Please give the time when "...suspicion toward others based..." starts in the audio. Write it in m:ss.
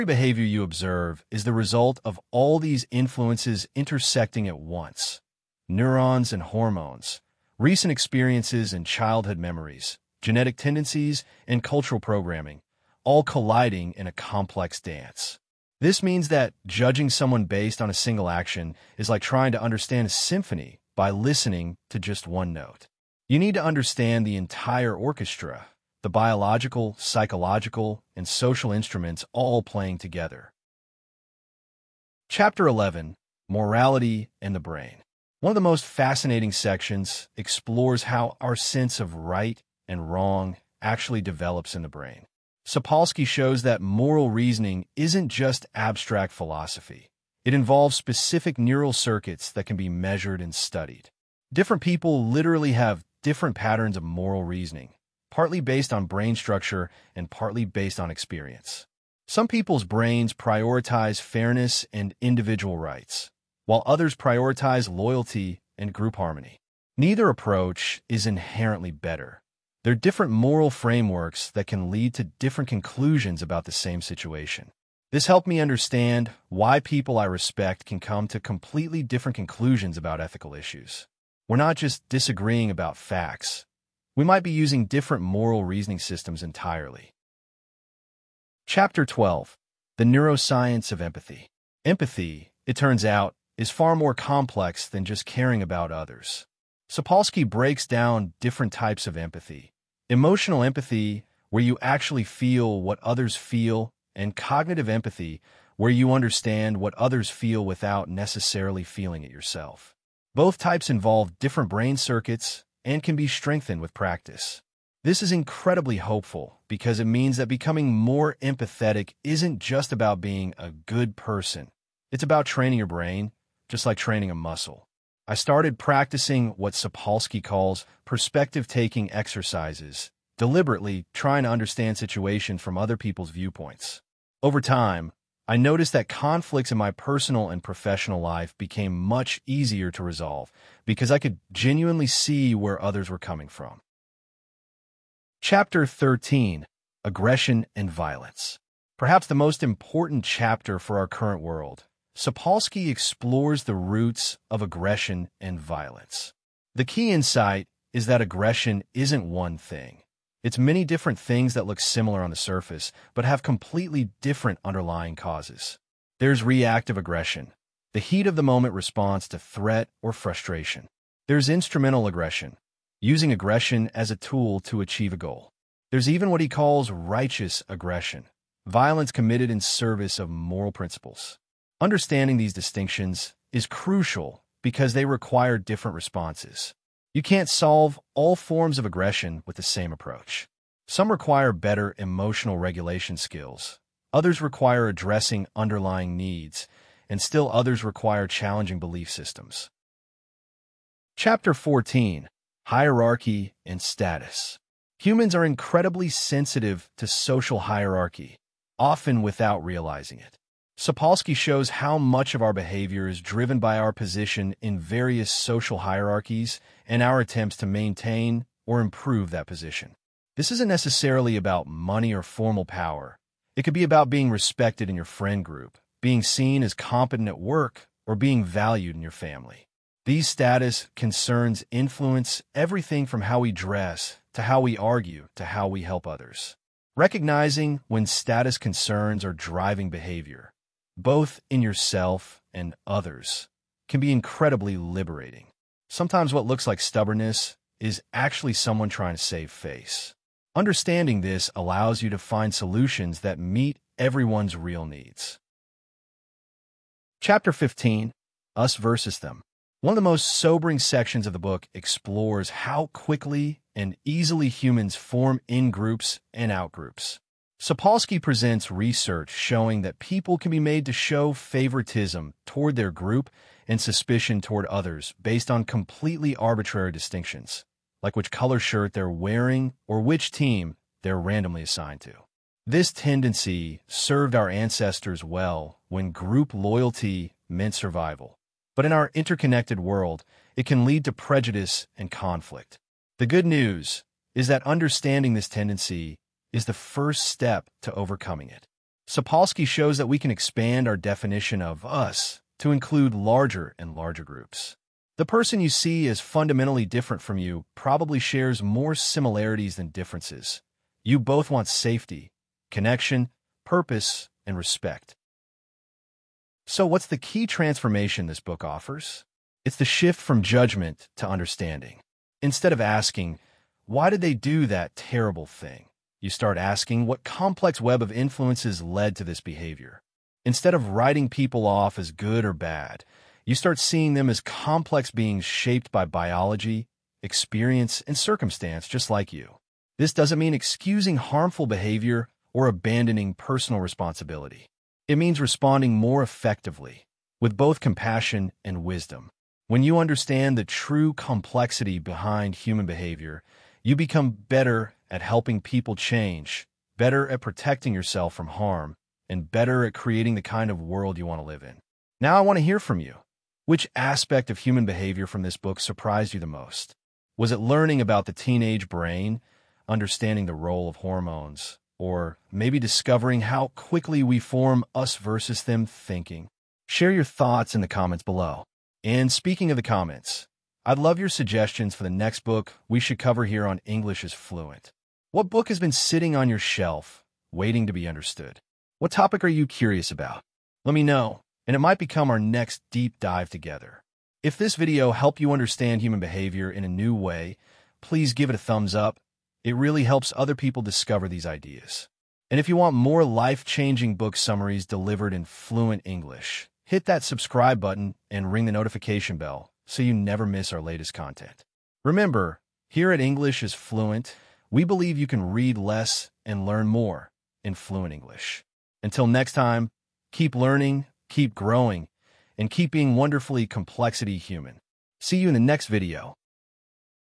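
4:33.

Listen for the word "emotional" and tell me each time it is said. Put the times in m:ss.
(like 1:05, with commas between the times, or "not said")
1:40, 3:11.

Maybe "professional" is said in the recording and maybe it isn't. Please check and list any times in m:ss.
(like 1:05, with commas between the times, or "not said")
2:17.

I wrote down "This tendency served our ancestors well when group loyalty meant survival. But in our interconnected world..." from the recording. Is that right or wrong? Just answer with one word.
right.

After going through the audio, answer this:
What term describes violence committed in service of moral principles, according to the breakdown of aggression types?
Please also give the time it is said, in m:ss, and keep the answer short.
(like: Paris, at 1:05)
righteous aggression, at 2:56.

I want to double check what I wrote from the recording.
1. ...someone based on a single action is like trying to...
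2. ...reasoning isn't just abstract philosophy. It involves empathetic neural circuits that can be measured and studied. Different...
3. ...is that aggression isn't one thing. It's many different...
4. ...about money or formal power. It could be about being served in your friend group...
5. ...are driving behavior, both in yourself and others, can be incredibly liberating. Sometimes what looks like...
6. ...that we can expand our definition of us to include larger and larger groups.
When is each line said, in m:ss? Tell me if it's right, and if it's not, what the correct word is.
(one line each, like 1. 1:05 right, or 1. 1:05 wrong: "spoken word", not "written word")
1. 0:17 right
2. 0:44 wrong: "specific", not "empathetic"
3. 2:37 right
4. 3:41 wrong: "respected", not "served"
5. 3:59 right
6. 4:59 right.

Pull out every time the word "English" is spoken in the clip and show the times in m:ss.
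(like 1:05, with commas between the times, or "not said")
6:23, 6:46, 6:53, 6:58.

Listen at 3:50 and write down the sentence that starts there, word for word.
These status concerns influence everything from how we dress to how we argue to how we help others.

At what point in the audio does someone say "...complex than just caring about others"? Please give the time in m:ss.
1:34.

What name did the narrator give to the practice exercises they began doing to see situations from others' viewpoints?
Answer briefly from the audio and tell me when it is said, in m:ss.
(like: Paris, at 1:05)
perspective-taking exercises, at 2:08.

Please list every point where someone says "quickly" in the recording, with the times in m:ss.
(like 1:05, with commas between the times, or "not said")
4:22, 6:13.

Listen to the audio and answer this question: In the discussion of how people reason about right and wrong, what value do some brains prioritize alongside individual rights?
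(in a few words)
fairness.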